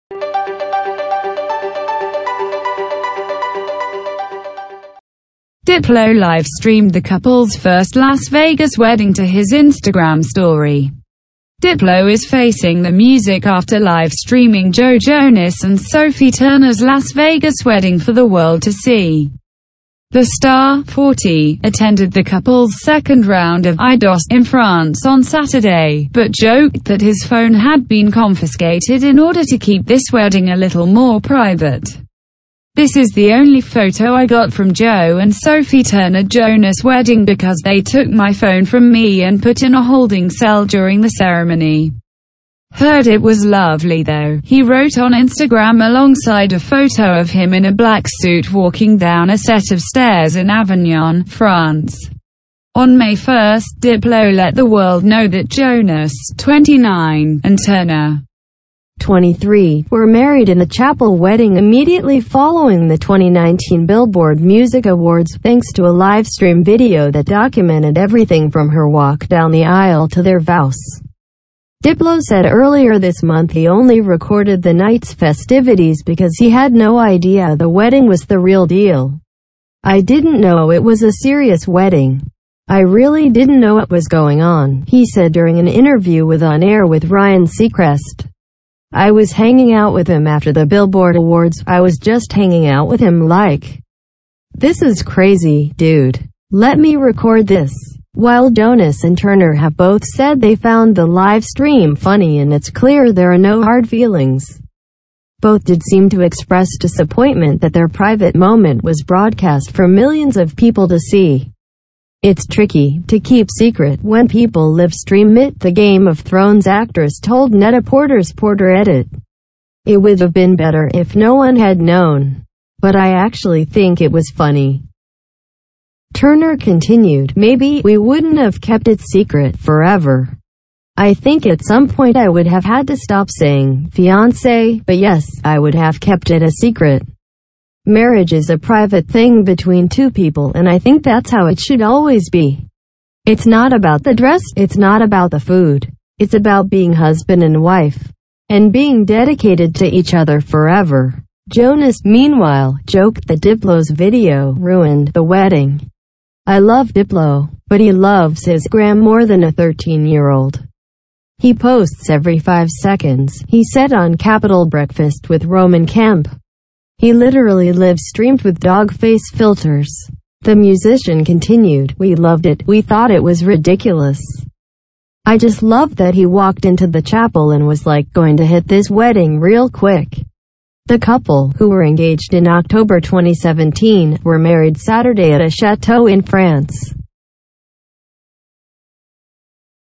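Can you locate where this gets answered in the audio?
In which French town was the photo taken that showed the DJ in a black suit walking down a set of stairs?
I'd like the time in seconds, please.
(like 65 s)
50 s.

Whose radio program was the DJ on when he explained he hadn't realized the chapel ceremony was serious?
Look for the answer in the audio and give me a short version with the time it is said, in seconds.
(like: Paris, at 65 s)
Ryan Seacrest, at 87 s.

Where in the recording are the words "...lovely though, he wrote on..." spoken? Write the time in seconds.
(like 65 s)
43 s.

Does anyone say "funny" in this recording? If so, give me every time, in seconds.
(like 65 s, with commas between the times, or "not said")
101 s, 124 s.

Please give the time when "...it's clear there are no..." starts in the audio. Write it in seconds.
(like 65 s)
102 s.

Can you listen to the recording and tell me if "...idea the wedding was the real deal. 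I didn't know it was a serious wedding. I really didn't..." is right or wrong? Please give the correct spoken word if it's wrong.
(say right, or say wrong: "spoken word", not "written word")
right.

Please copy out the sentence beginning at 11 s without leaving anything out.
Diplo is facing the music after live streaming Joe Jonas and Sophie Turner's Las Vegas wedding for the world to see.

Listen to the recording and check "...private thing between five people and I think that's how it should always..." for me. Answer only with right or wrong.
wrong.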